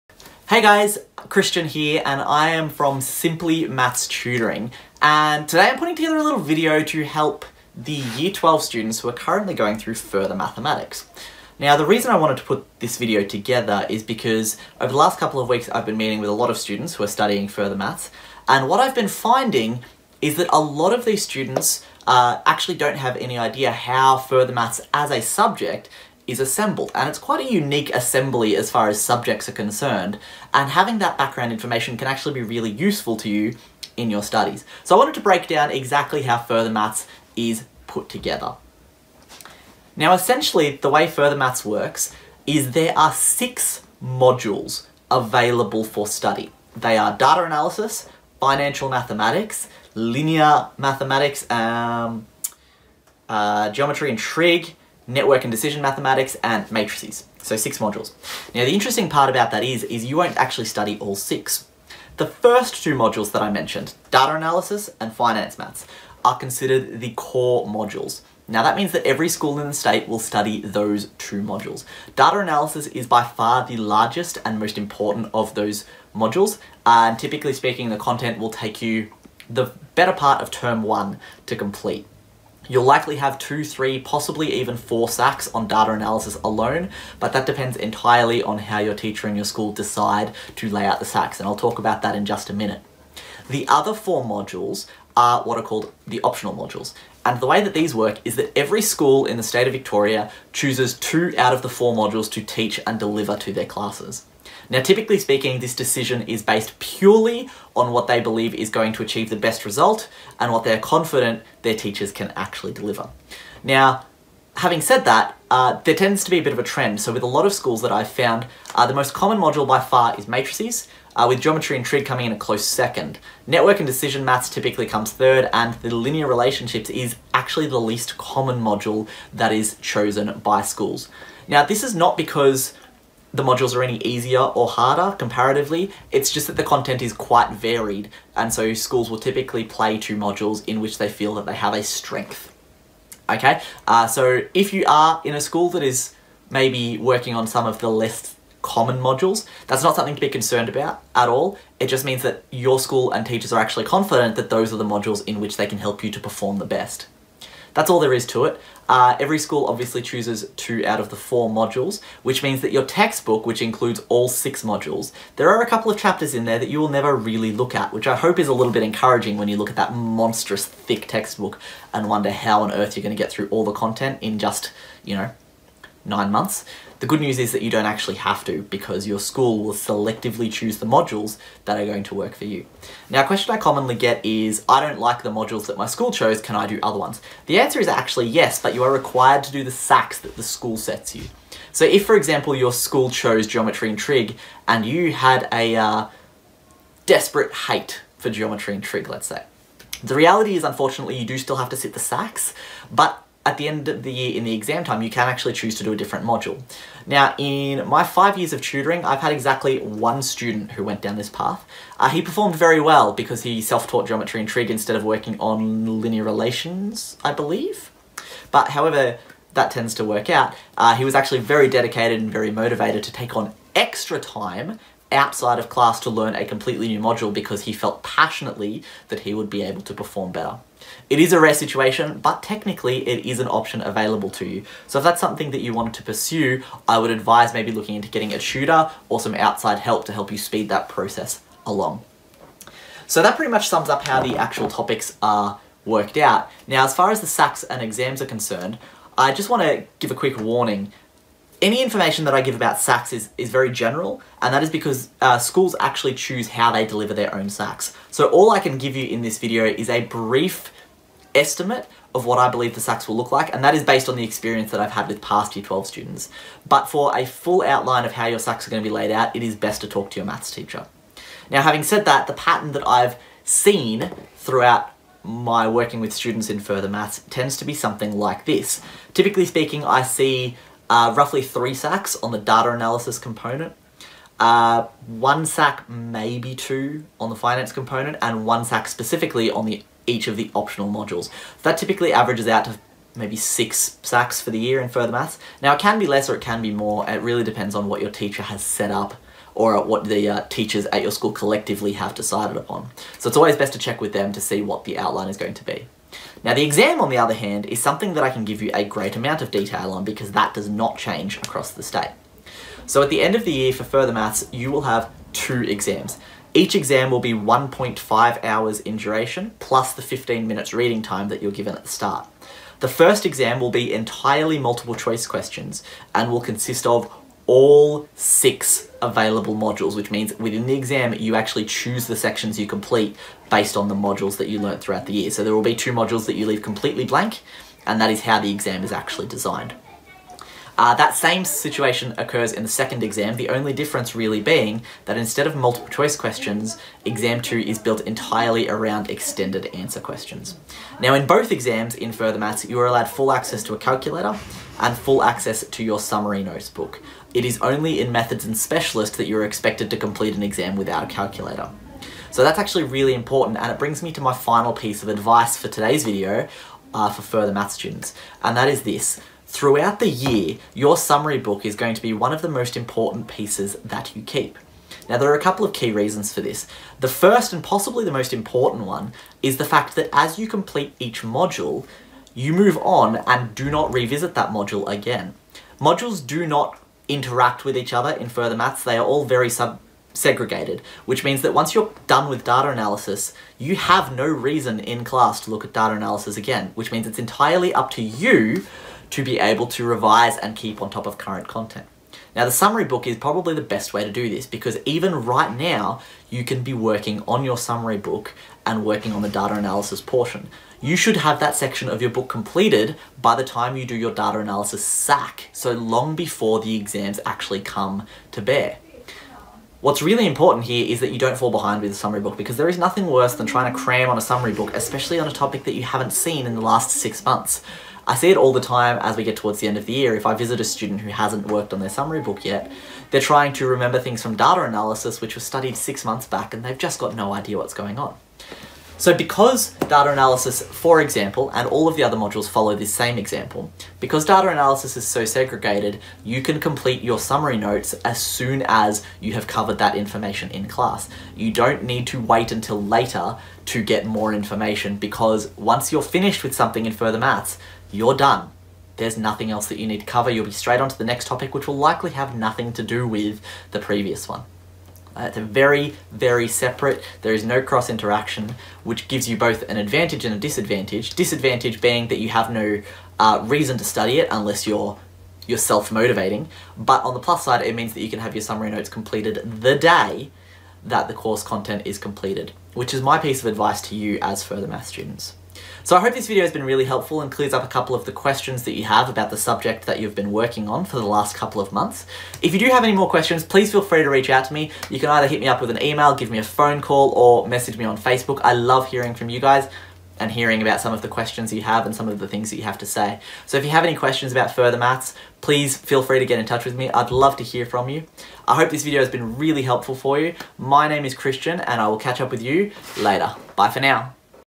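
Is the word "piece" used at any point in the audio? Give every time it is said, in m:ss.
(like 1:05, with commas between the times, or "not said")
6:04, 6:13, 8:03.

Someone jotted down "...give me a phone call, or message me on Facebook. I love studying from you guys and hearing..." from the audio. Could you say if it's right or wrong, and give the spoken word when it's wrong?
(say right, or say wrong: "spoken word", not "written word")
wrong: "hearing", not "studying".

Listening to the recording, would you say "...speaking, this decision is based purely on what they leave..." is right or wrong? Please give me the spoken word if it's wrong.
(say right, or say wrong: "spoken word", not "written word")
wrong: "believe", not "leave".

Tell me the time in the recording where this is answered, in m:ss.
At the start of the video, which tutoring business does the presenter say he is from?
0:02.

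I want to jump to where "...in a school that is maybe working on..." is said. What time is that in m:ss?
2:25.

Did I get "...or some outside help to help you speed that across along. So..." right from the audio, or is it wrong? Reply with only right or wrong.
wrong.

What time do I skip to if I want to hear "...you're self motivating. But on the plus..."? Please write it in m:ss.
7:54.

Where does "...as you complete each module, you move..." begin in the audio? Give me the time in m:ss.
6:20.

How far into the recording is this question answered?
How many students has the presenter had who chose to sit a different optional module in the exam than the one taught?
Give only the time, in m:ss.
3:29.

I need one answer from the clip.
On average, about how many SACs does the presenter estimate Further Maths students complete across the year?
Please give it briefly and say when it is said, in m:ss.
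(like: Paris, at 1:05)
6, at 4:53.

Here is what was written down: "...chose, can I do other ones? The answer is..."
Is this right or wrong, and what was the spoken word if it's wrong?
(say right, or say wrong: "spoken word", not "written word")
right.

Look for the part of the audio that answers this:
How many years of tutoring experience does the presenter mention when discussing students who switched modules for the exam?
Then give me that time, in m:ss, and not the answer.
3:28.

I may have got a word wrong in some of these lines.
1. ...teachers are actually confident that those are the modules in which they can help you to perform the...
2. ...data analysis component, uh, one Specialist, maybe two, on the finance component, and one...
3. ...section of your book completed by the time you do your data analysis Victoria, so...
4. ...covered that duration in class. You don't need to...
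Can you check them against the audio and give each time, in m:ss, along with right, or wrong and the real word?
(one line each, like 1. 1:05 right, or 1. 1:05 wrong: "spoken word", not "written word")
1. 2:33 right
2. 4:42 wrong: "SAC", not "Specialist"
3. 6:51 wrong: "SAC", not "Victoria"
4. 7:29 wrong: "information", not "duration".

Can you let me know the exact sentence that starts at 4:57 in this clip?
It really depends on what your teacher has set up or what the uh, teachers at your school collectively have decided upon.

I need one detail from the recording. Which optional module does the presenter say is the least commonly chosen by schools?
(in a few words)
Linear relationships.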